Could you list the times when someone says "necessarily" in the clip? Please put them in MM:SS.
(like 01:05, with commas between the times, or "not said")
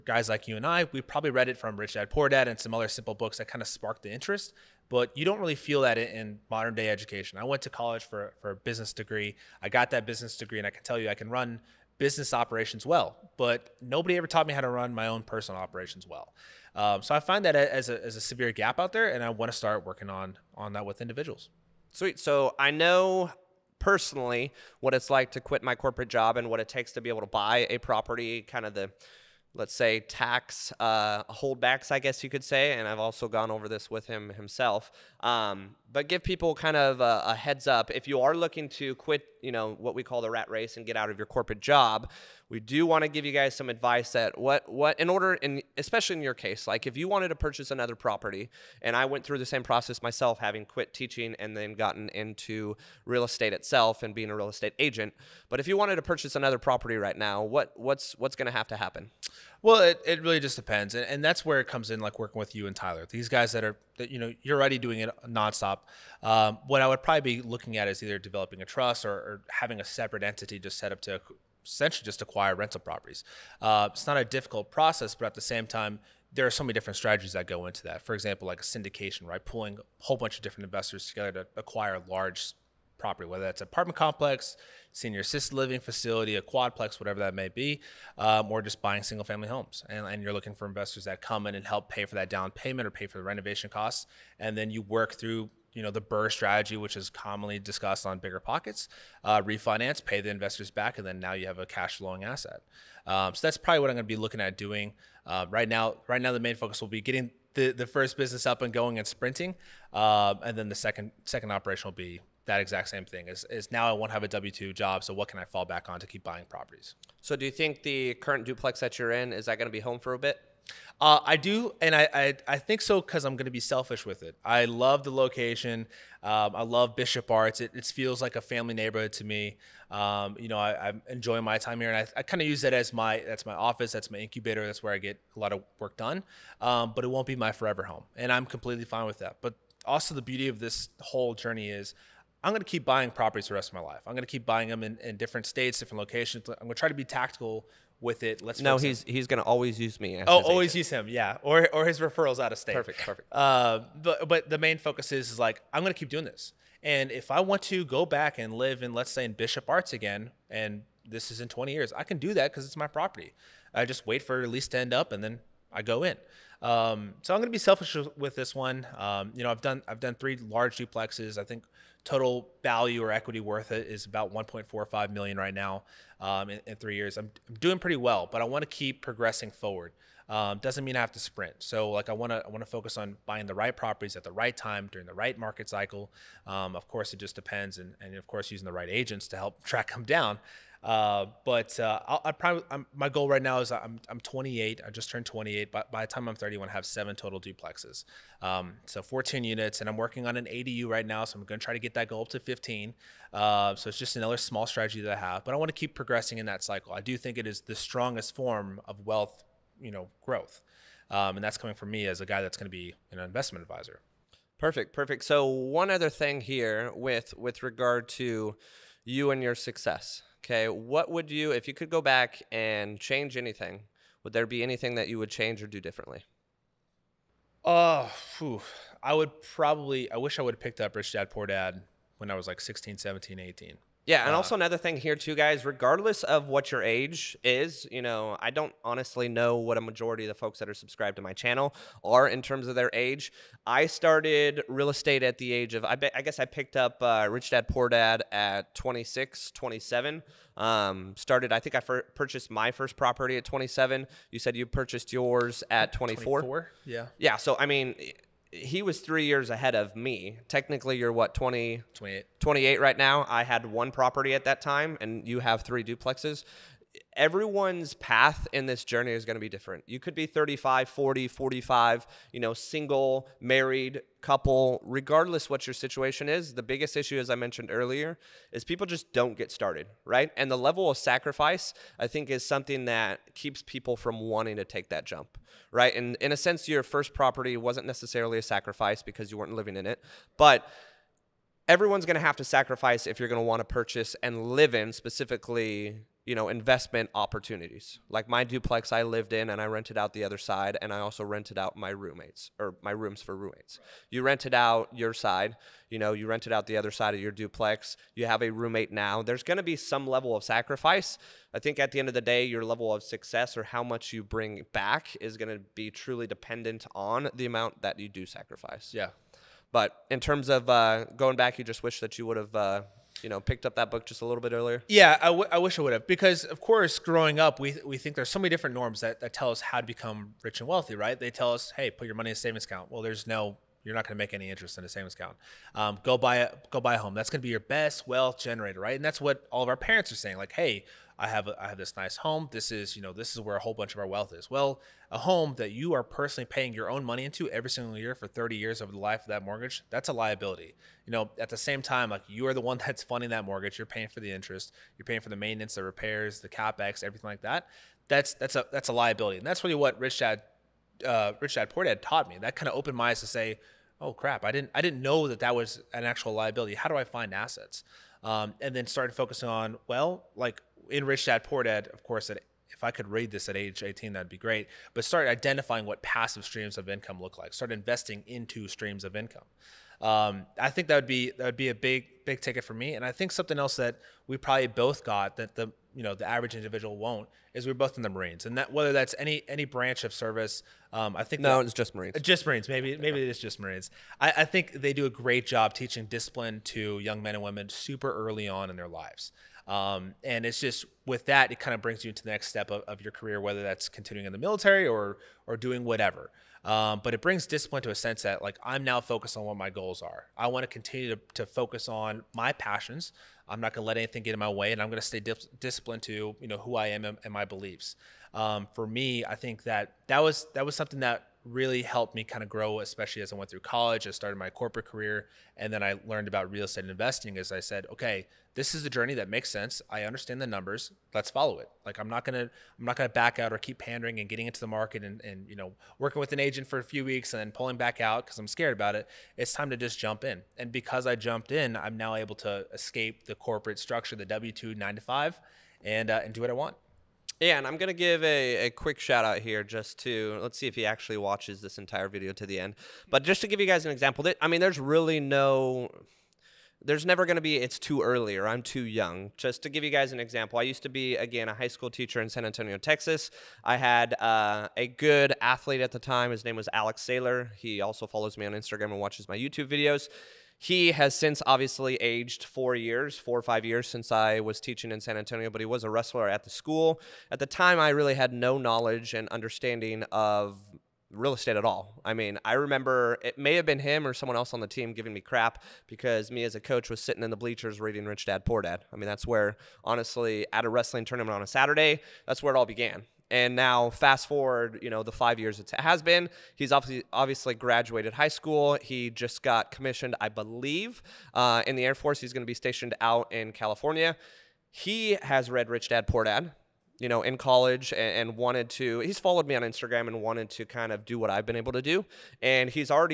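04:47.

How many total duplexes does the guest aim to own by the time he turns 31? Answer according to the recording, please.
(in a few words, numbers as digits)
7.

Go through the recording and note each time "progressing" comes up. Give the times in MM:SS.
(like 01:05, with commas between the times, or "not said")
02:59, 03:25.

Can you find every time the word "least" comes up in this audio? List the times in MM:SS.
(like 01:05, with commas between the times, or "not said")
02:44.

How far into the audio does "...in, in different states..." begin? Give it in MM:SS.
02:24.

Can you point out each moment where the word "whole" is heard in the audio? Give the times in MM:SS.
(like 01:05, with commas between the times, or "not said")
01:20, 02:20, 05:43.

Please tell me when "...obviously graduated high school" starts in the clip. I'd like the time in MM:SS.
08:17.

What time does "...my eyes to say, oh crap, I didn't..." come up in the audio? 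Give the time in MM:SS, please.
06:02.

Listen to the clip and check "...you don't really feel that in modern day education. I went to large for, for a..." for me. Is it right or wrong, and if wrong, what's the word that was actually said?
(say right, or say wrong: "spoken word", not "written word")
wrong: "college", not "large".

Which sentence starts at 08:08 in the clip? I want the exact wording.
I mean, that's where honestly at a wrestling tournament on a Saturday, that's where it all began.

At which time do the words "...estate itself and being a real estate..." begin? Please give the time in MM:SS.
00:53.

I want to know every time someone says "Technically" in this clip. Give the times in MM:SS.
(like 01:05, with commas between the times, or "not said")
04:20.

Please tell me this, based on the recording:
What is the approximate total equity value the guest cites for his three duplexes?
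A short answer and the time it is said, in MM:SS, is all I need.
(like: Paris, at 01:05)
1.45 million, at 02:54.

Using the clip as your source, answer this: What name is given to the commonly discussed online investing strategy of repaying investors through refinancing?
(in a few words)
BRRRR strategy.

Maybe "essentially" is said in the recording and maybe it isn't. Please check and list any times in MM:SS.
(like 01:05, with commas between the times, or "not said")
01:11.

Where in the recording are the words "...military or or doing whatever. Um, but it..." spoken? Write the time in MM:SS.
06:44.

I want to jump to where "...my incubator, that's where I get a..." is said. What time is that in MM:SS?
02:14.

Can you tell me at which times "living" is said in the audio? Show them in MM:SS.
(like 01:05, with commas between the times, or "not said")
01:25, 04:49.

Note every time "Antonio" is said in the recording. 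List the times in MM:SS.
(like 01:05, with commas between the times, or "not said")
07:42, 07:55.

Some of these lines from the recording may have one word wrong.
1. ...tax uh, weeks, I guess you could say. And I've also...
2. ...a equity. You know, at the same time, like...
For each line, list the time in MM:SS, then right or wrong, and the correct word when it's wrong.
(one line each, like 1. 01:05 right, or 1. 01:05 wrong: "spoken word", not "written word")
1. 00:30 wrong: "holdbacks", not "weeks"
2. 05:50 wrong: "liability", not "equity".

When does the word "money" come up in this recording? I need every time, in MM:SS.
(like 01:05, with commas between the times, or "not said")
05:32, 05:47.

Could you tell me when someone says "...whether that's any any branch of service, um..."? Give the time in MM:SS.
06:28.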